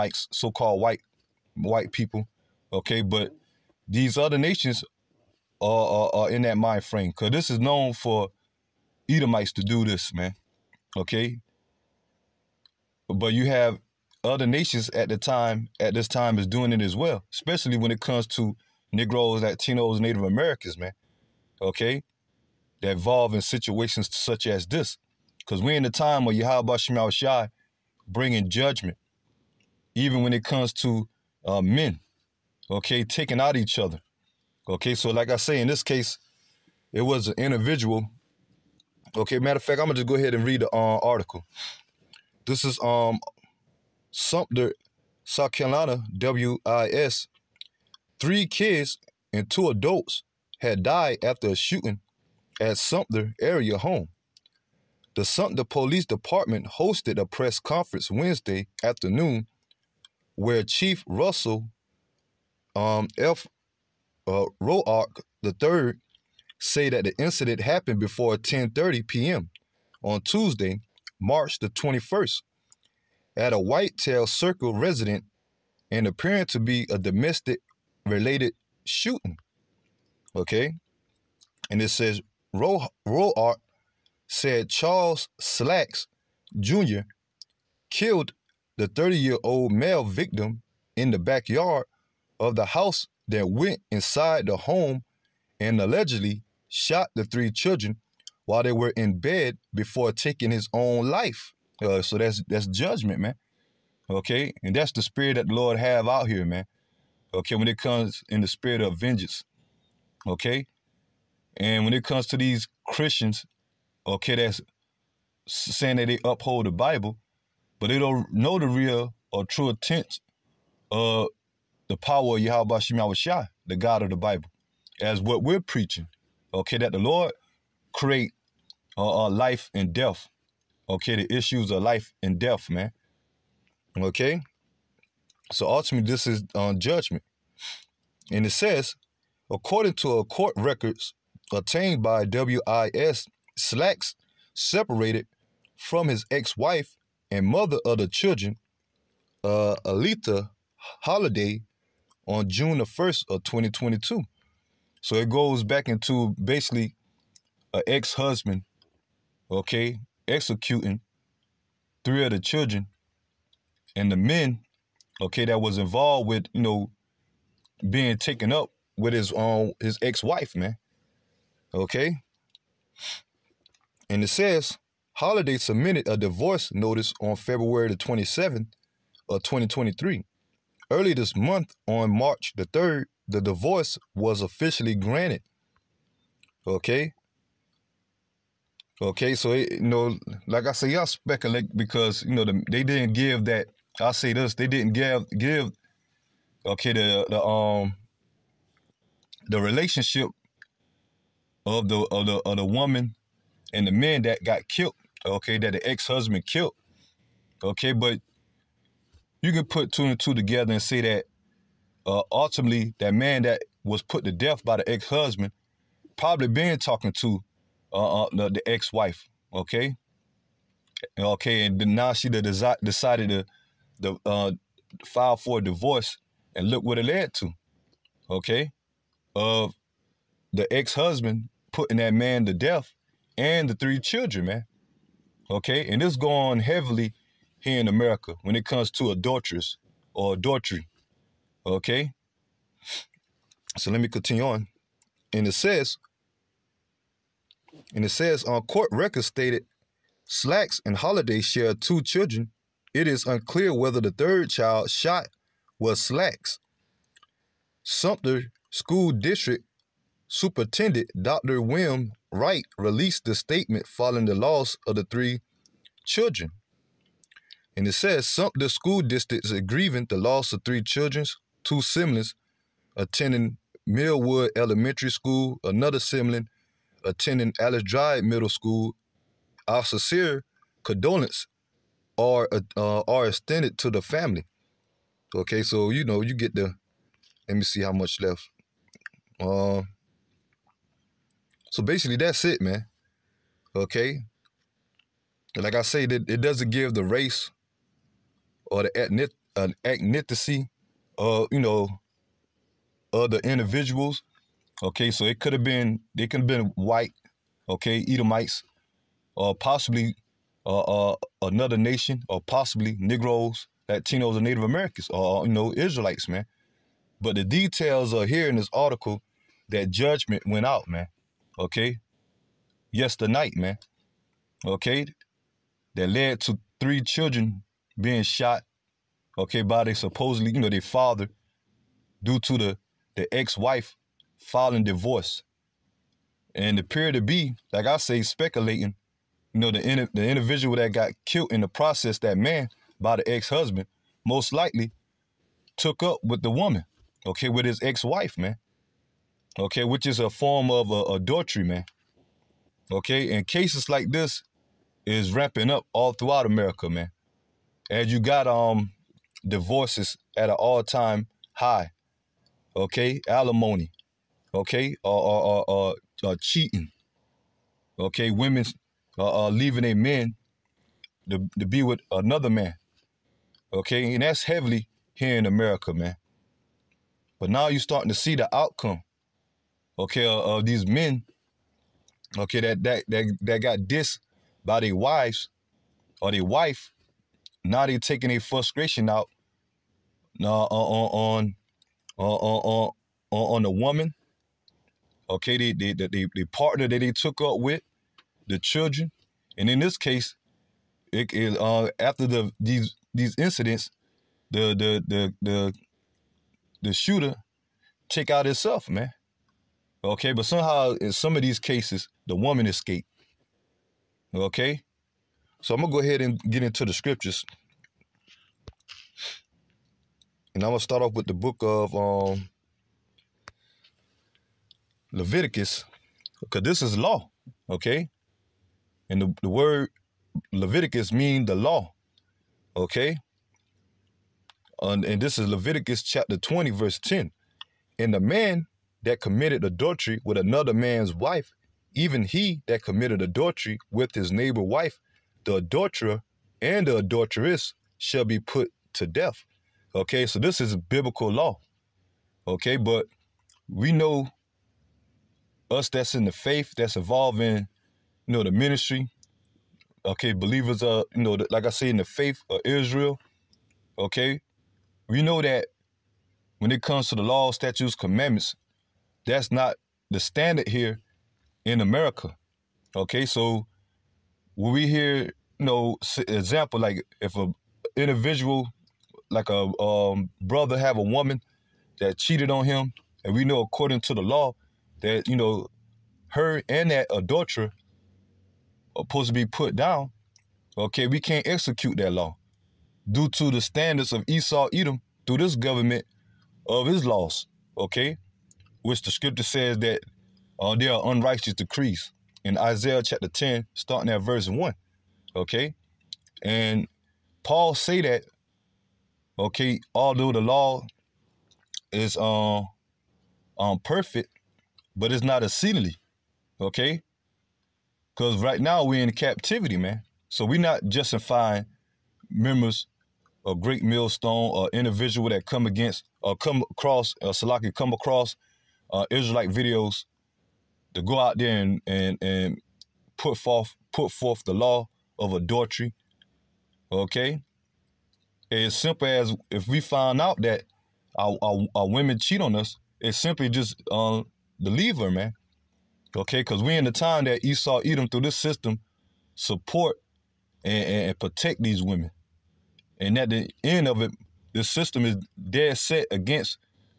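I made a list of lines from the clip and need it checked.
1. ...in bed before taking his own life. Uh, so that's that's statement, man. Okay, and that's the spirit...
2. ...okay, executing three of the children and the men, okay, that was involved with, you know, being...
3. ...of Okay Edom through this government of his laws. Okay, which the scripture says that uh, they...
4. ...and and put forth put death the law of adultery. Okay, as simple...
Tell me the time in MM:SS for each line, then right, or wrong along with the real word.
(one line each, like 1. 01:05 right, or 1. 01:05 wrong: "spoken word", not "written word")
1. 01:38 wrong: "judgment", not "statement"
2. 02:39 right
3. 08:14 wrong: "Esau", not "Okay"
4. 08:51 wrong: "forth", not "death".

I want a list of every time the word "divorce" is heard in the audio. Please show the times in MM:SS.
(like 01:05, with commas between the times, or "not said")
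02:56, 03:03, 03:45, 05:34, 05:59.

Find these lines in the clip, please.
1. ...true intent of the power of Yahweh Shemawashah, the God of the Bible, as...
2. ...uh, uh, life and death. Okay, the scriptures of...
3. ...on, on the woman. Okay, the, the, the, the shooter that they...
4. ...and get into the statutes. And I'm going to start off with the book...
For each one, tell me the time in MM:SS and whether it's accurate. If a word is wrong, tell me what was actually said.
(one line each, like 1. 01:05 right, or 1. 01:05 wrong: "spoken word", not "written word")
1. 01:59 right
2. 02:08 wrong: "issues", not "scriptures"
3. 06:33 wrong: "partner", not "shooter"
4. 06:56 wrong: "scriptures", not "statutes".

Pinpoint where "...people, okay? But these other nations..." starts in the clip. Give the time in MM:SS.
00:01.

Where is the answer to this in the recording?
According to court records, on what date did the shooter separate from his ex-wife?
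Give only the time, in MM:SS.
02:32.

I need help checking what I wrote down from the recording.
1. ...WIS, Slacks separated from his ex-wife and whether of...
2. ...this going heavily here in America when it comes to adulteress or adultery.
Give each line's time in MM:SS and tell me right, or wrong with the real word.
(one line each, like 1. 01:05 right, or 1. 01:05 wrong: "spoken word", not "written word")
1. 02:22 wrong: "mother", not "whether"
2. 03:56 right.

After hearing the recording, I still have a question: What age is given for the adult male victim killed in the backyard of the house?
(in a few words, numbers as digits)
30.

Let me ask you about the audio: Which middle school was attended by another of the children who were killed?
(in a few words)
Alice Drive Middle School.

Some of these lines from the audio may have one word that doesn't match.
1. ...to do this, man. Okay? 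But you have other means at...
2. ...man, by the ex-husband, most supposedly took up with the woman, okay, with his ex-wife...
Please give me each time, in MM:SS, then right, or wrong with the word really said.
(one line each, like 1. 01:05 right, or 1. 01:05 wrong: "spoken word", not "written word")
1. 00:09 wrong: "nations", not "means"
2. 05:42 wrong: "likely", not "supposedly".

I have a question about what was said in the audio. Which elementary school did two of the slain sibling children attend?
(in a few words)
Millwood Elementary School.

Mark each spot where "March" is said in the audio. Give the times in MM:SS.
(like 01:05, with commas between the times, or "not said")
01:11, 03:02.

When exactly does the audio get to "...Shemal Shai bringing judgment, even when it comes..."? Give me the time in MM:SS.
00:26.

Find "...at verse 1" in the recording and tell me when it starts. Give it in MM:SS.
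08:24.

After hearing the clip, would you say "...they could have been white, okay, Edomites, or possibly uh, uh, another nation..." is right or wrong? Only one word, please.
right.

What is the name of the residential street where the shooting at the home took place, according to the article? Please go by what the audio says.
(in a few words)
Whitetail Circle.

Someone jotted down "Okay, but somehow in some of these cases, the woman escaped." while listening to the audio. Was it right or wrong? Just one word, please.
right.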